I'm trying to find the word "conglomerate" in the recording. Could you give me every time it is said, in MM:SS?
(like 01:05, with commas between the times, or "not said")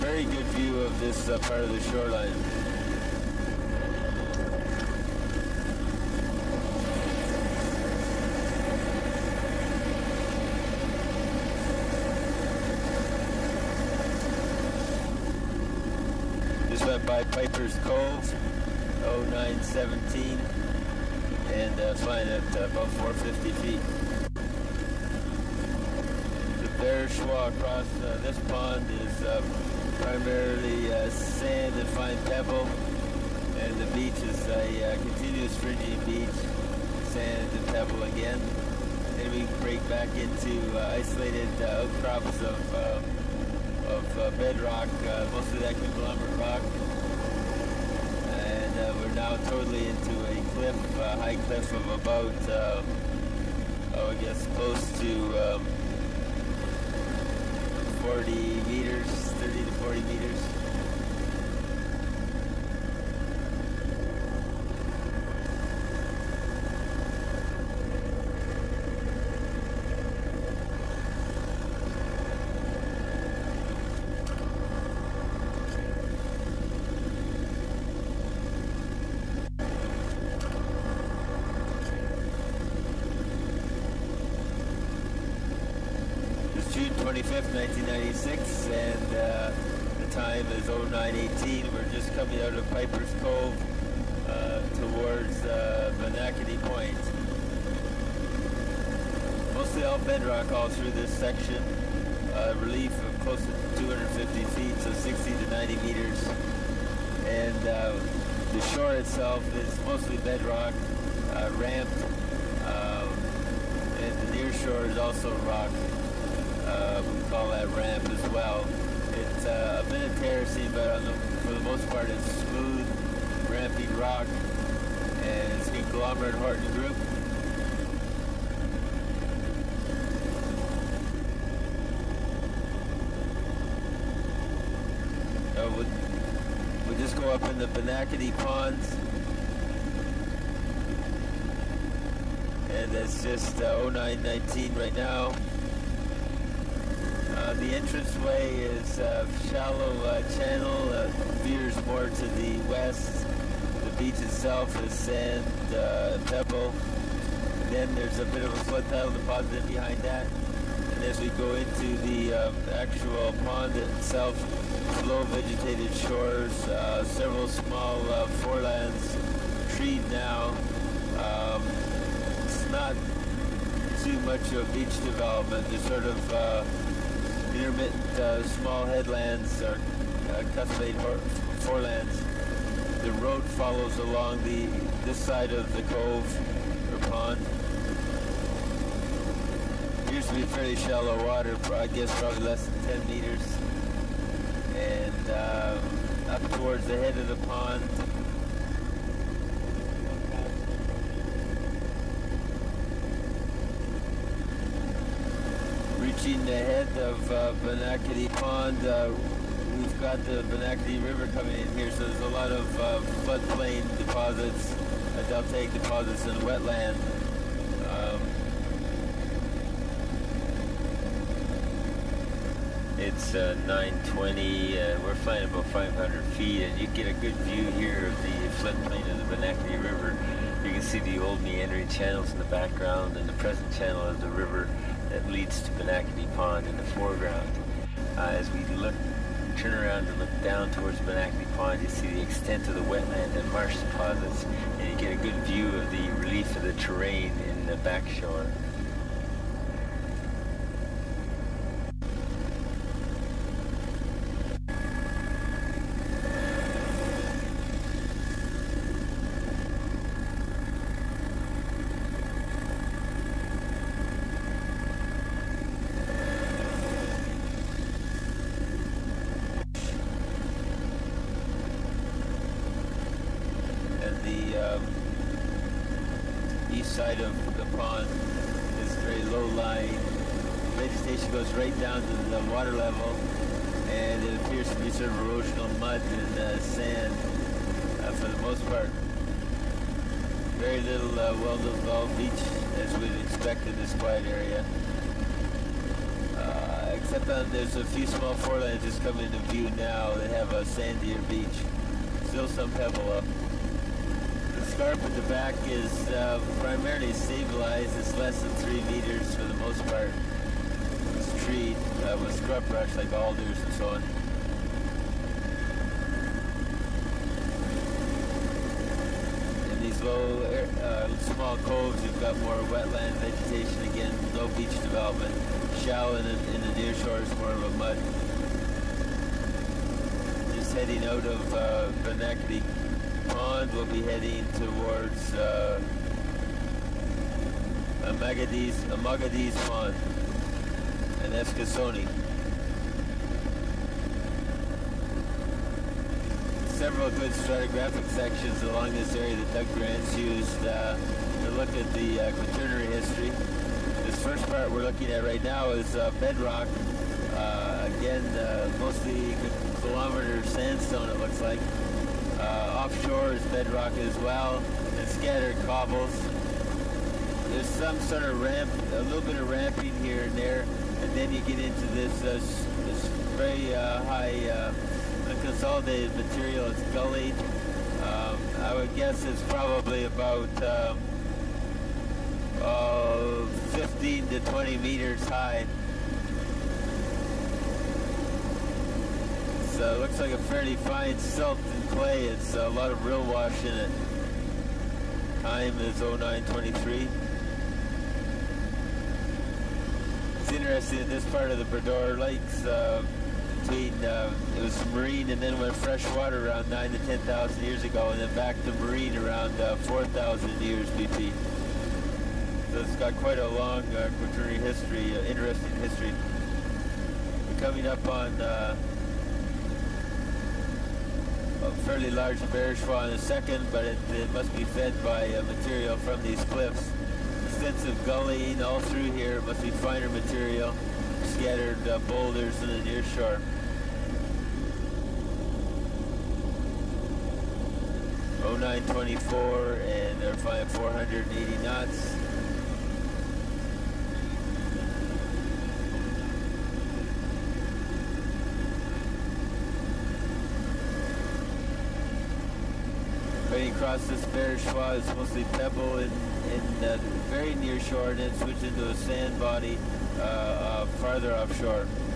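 00:45, 02:05.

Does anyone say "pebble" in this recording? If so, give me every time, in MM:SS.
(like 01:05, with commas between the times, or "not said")
00:32, 00:37, 02:36, 05:02, 07:35.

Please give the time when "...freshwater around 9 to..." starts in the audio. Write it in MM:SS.
06:45.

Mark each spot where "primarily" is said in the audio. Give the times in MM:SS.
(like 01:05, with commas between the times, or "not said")
00:30, 05:06.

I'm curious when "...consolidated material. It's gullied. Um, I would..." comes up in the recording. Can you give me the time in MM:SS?
06:15.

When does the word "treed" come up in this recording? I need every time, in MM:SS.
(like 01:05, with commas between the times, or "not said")
02:49, 05:11.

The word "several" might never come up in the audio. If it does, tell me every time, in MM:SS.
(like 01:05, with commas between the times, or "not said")
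02:47, 05:46.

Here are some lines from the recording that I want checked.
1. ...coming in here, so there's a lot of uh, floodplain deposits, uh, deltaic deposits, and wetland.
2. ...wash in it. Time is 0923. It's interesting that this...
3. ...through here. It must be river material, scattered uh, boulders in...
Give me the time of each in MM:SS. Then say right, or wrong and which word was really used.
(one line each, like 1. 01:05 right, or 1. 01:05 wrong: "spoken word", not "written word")
1. 03:31 right
2. 06:33 right
3. 07:08 wrong: "finer", not "river".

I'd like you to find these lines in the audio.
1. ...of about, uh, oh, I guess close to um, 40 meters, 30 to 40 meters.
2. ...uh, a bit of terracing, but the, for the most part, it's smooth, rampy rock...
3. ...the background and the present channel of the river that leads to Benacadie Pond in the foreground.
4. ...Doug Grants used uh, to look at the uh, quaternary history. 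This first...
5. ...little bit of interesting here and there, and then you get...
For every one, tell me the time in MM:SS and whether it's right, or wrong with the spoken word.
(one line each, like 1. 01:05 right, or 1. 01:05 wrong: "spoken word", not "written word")
1. 00:51 right
2. 01:59 right
3. 03:52 right
4. 05:49 right
5. 06:09 wrong: "ramping", not "interesting".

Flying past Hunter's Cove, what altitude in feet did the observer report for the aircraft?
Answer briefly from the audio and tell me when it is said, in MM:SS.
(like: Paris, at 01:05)
450 feet, at 00:22.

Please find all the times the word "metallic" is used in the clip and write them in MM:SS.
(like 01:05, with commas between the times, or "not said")
not said.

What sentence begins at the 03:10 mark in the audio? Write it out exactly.
Used to be fairly shallow water, I guess probably less than 10 meters.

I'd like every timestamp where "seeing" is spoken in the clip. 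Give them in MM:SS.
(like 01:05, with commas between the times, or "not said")
not said.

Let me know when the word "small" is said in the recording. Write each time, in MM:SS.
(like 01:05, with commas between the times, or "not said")
02:47, 02:58, 04:58, 05:21.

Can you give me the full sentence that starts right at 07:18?
O oh nine twenty four and they're flying 480 knots.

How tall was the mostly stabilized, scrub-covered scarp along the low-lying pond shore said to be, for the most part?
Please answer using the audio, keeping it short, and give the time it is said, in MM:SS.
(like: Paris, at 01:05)
less than 3 meters, at 05:08.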